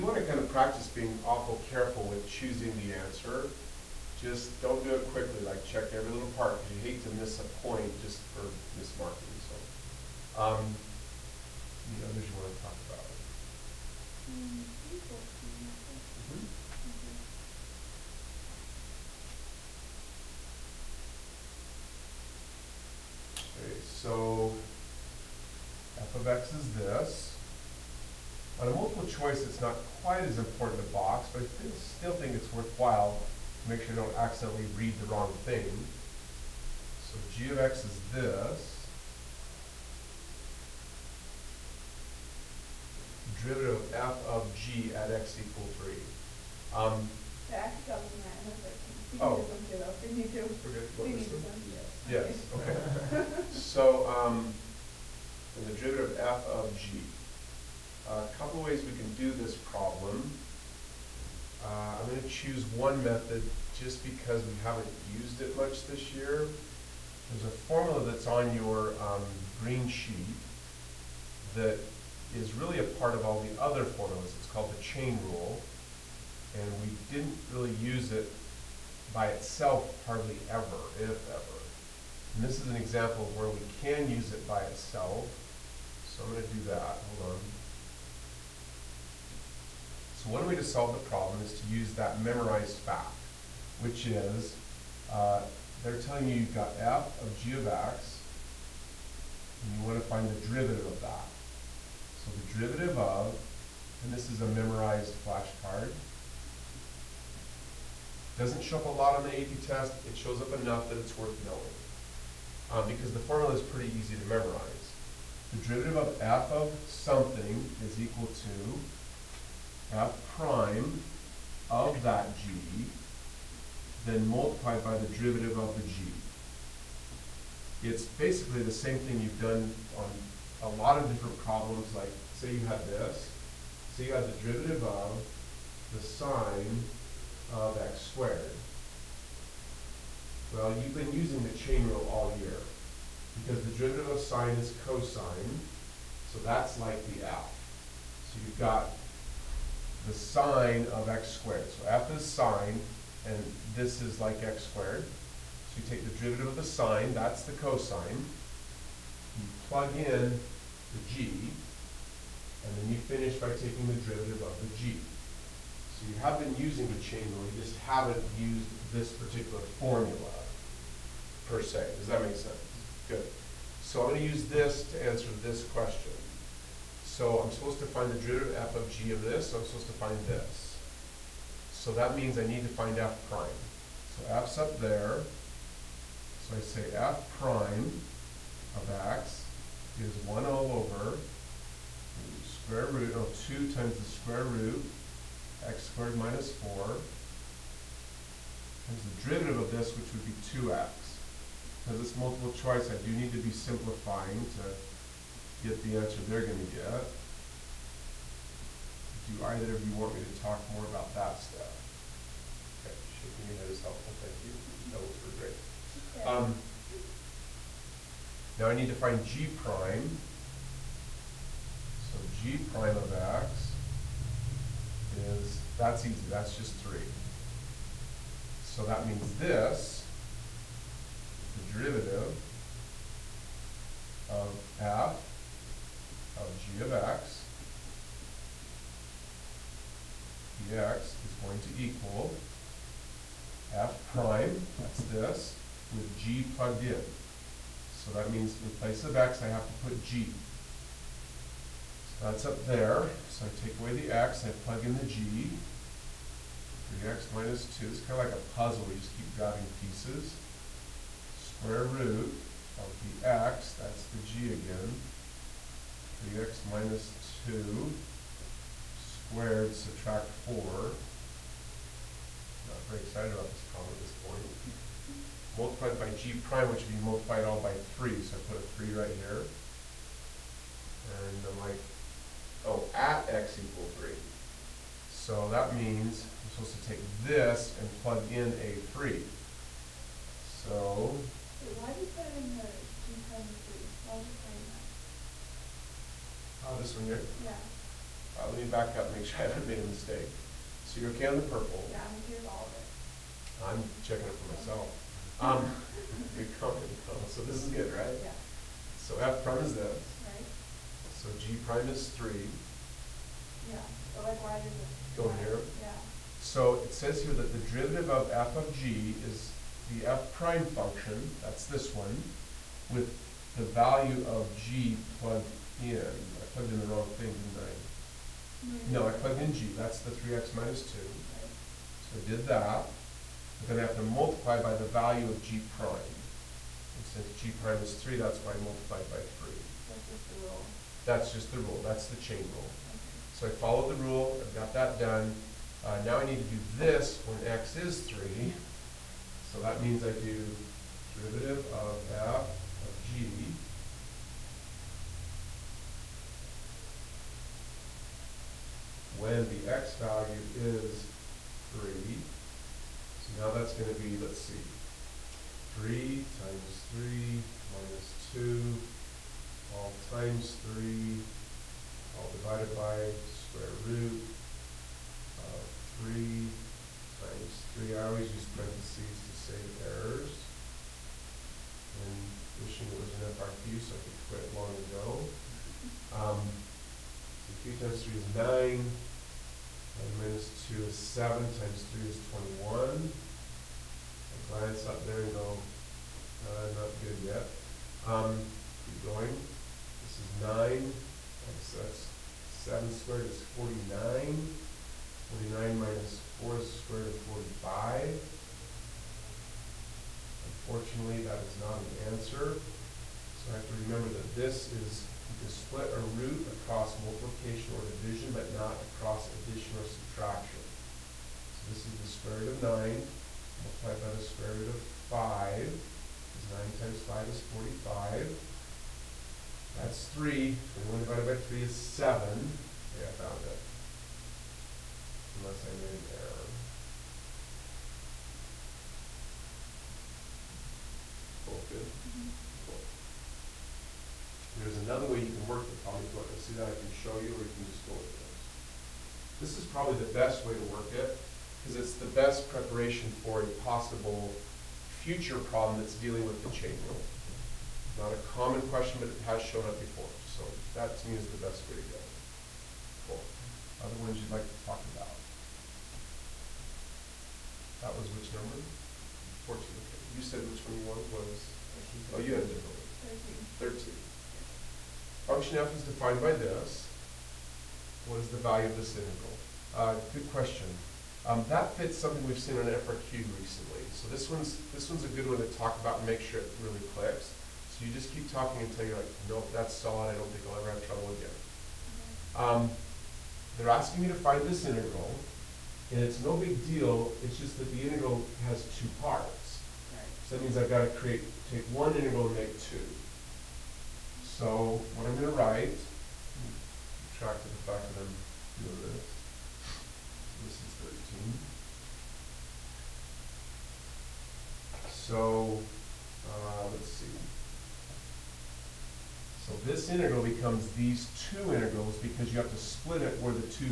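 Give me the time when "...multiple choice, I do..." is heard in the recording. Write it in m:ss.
3:22.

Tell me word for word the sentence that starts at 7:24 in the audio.
There's another way you can work with comic book.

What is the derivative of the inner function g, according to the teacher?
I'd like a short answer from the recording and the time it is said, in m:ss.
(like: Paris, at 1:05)
3, at 3:46.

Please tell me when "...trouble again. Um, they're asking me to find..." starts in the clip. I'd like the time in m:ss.
8:10.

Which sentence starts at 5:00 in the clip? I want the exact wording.
So you're okay on the purple.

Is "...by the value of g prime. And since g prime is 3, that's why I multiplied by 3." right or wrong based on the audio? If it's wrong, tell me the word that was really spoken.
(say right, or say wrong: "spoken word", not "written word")
right.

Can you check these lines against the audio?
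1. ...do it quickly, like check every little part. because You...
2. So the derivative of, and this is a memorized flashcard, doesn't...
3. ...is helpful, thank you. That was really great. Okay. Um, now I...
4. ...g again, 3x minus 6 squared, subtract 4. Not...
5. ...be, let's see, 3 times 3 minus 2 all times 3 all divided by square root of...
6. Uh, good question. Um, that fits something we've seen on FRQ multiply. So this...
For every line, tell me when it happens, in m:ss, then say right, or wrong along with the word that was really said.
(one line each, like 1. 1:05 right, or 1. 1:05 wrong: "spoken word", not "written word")
1. 0:04 right
2. 1:42 right
3. 3:33 right
4. 4:24 wrong: "2", not "6"
5. 6:04 right
6. 7:59 wrong: "recently", not "multiply".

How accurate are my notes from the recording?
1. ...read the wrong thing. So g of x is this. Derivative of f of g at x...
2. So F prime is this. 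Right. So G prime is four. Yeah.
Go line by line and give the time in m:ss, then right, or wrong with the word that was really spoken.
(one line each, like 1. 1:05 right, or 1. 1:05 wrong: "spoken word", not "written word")
1. 0:34 right
2. 5:08 wrong: "three", not "four".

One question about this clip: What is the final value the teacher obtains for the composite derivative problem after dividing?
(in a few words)
7.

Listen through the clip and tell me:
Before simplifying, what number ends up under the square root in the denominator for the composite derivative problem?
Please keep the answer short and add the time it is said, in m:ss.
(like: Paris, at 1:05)
45, at 6:46.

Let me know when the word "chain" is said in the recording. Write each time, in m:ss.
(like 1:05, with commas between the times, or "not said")
1:14, 2:21, 2:47, 5:42, 7:36.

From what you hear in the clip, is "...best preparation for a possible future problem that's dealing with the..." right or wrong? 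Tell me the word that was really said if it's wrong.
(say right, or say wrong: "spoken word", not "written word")
right.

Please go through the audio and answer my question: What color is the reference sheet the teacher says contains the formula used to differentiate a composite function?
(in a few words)
green.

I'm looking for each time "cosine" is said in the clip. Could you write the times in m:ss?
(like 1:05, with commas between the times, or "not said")
2:24, 2:37.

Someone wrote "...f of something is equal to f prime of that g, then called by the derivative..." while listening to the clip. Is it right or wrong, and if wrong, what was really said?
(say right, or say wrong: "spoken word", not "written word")
wrong: "multiplied", not "called".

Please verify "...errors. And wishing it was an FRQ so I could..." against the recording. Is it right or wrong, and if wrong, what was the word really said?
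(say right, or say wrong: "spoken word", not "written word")
right.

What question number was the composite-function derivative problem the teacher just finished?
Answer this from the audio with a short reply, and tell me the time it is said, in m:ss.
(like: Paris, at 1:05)
14, at 7:49.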